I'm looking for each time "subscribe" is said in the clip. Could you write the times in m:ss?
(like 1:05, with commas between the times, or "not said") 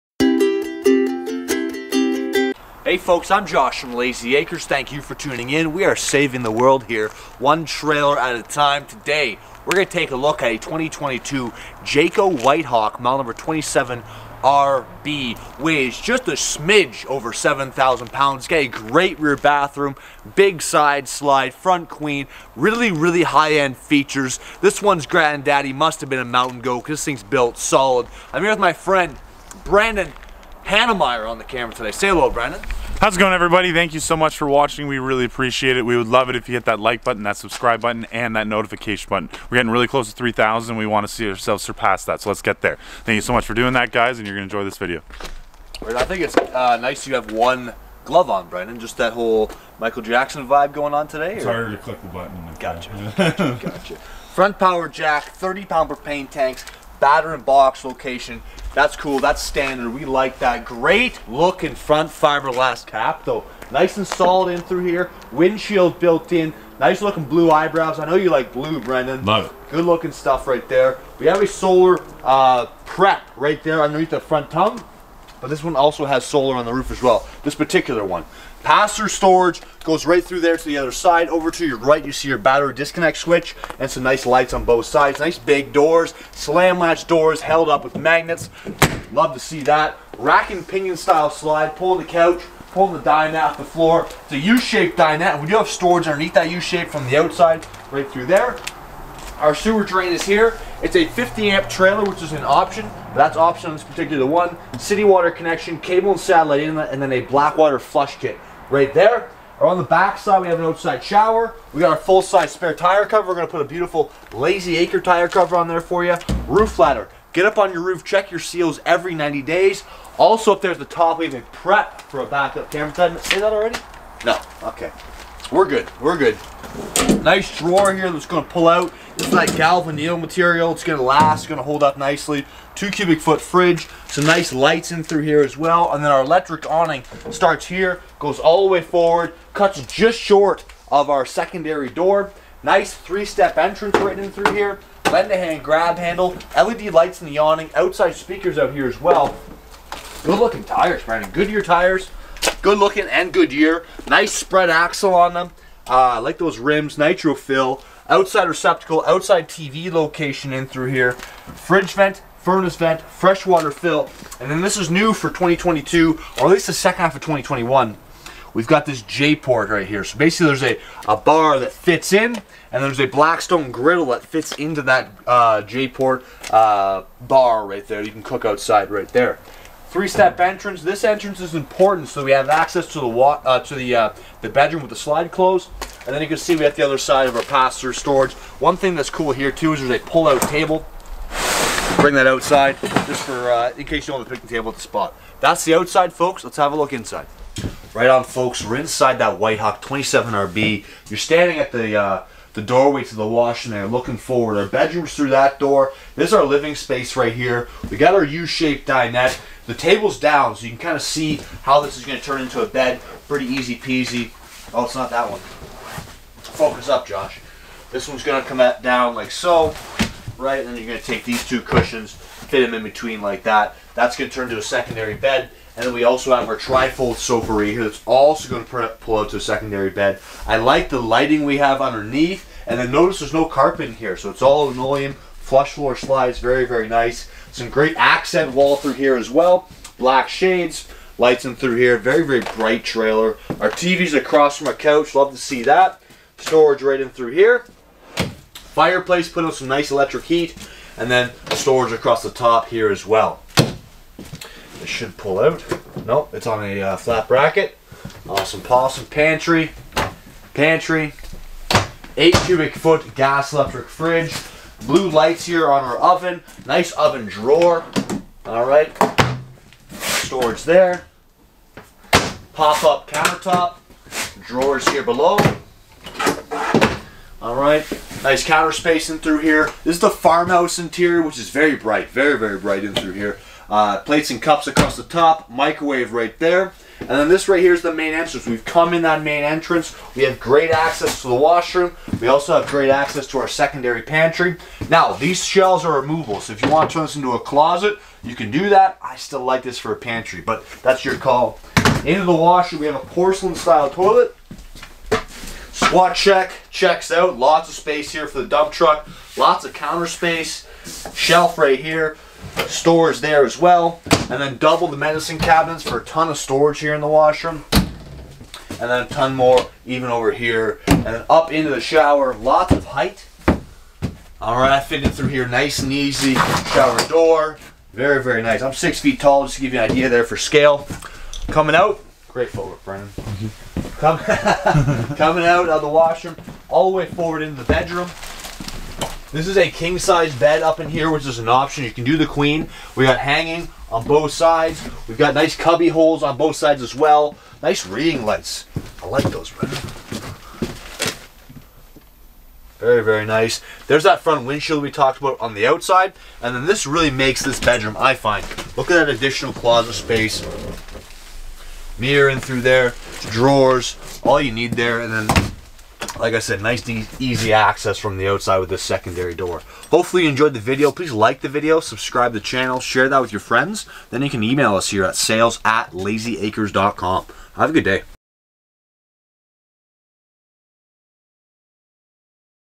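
0:37, 6:11.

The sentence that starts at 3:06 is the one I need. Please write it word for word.
And then you can see we have the other side of our pass-through storage.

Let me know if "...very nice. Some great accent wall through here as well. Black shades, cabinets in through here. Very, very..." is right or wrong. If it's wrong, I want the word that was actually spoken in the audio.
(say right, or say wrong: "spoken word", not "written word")
wrong: "lights", not "cabinets".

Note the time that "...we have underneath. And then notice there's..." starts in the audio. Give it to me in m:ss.
3:51.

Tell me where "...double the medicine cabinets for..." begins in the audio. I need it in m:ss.
5:14.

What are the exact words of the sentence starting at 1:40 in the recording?
It's a 50 amp trailer, which is an option.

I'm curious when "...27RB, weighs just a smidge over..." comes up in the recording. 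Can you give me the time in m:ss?
0:13.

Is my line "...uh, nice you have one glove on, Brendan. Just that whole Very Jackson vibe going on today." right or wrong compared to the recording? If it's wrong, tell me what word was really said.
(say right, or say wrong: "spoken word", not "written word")
wrong: "Michael", not "Very".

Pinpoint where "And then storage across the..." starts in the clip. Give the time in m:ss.
4:10.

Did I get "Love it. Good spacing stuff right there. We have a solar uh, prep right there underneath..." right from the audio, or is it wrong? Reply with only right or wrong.
wrong.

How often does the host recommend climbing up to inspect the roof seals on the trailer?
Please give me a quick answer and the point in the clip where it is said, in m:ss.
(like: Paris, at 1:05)
every 90 days, at 1:58.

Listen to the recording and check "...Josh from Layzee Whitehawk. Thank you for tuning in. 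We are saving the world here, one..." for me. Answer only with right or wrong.
wrong.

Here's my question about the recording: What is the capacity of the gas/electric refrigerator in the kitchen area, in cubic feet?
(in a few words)
8 cubic feet.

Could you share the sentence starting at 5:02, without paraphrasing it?
Into the washroom, we have a porcelain-style toilet.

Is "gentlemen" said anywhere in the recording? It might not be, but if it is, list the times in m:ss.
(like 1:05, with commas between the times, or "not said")
not said.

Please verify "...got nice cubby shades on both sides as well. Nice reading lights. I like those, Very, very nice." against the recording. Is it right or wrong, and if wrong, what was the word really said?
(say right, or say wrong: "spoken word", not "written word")
wrong: "holes", not "shades".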